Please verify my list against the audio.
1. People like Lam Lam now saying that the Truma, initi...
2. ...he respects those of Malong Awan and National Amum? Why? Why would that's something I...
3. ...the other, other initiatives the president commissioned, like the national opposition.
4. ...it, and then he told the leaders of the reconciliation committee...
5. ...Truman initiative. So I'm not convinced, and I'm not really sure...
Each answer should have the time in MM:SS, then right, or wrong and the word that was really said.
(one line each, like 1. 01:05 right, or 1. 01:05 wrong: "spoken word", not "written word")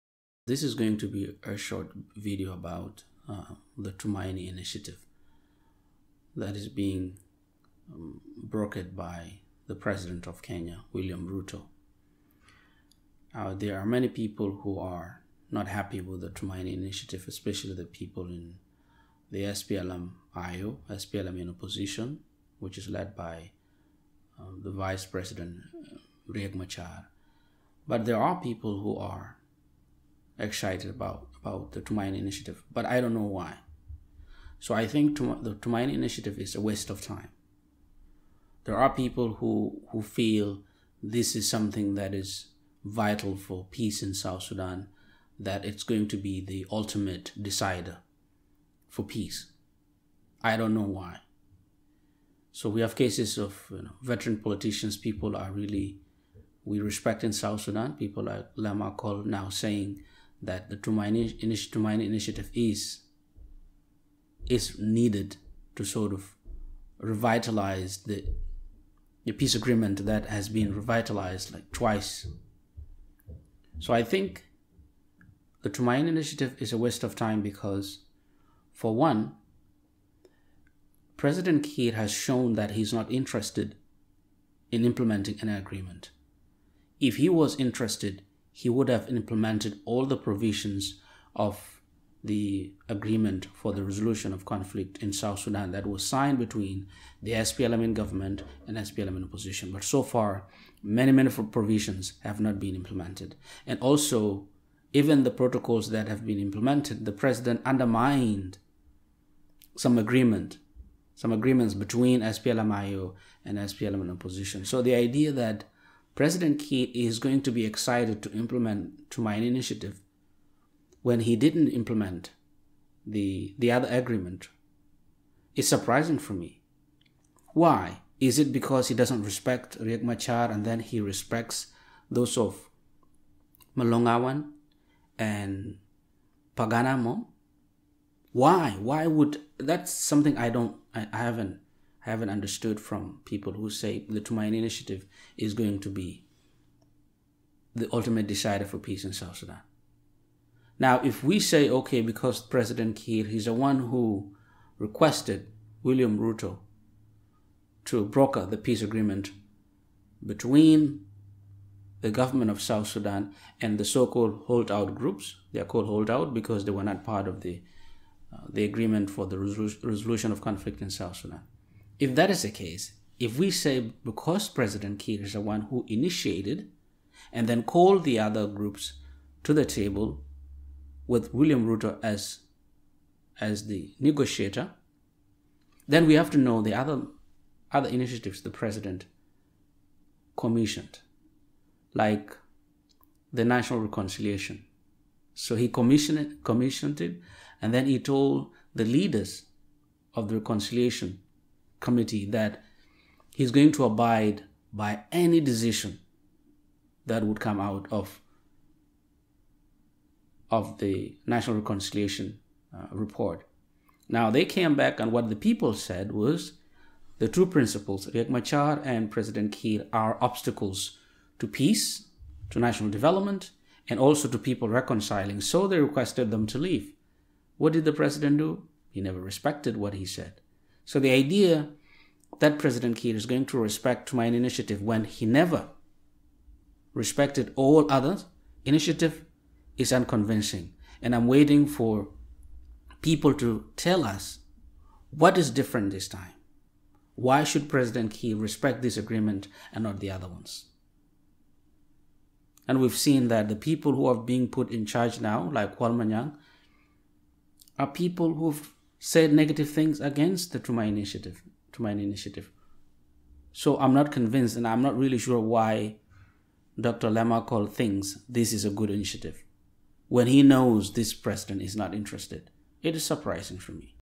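1. 00:57 wrong: "Akol", not "Lam"
2. 02:10 wrong: "Pagan", not "National"
3. 03:06 wrong: "reconciliation", not "opposition"
4. 03:16 right
5. 04:21 right.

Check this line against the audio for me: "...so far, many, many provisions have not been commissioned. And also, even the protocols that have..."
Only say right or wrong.
wrong.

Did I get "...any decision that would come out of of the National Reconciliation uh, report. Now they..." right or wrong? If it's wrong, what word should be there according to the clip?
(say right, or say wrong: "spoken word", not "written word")
right.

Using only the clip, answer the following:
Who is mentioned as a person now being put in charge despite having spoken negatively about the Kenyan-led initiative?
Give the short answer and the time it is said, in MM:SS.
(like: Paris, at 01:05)
Kuol Manyang, at 04:15.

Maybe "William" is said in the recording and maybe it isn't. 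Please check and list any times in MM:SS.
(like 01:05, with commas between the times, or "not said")
00:10, 02:35, 03:01.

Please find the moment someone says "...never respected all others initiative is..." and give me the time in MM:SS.
03:55.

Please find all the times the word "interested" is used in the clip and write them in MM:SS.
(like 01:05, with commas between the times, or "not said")
01:23, 01:27, 04:31.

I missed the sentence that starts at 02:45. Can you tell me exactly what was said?
They are called holdout because they were not part of the uh, the agreement for the resolution of conflict in South Sudan.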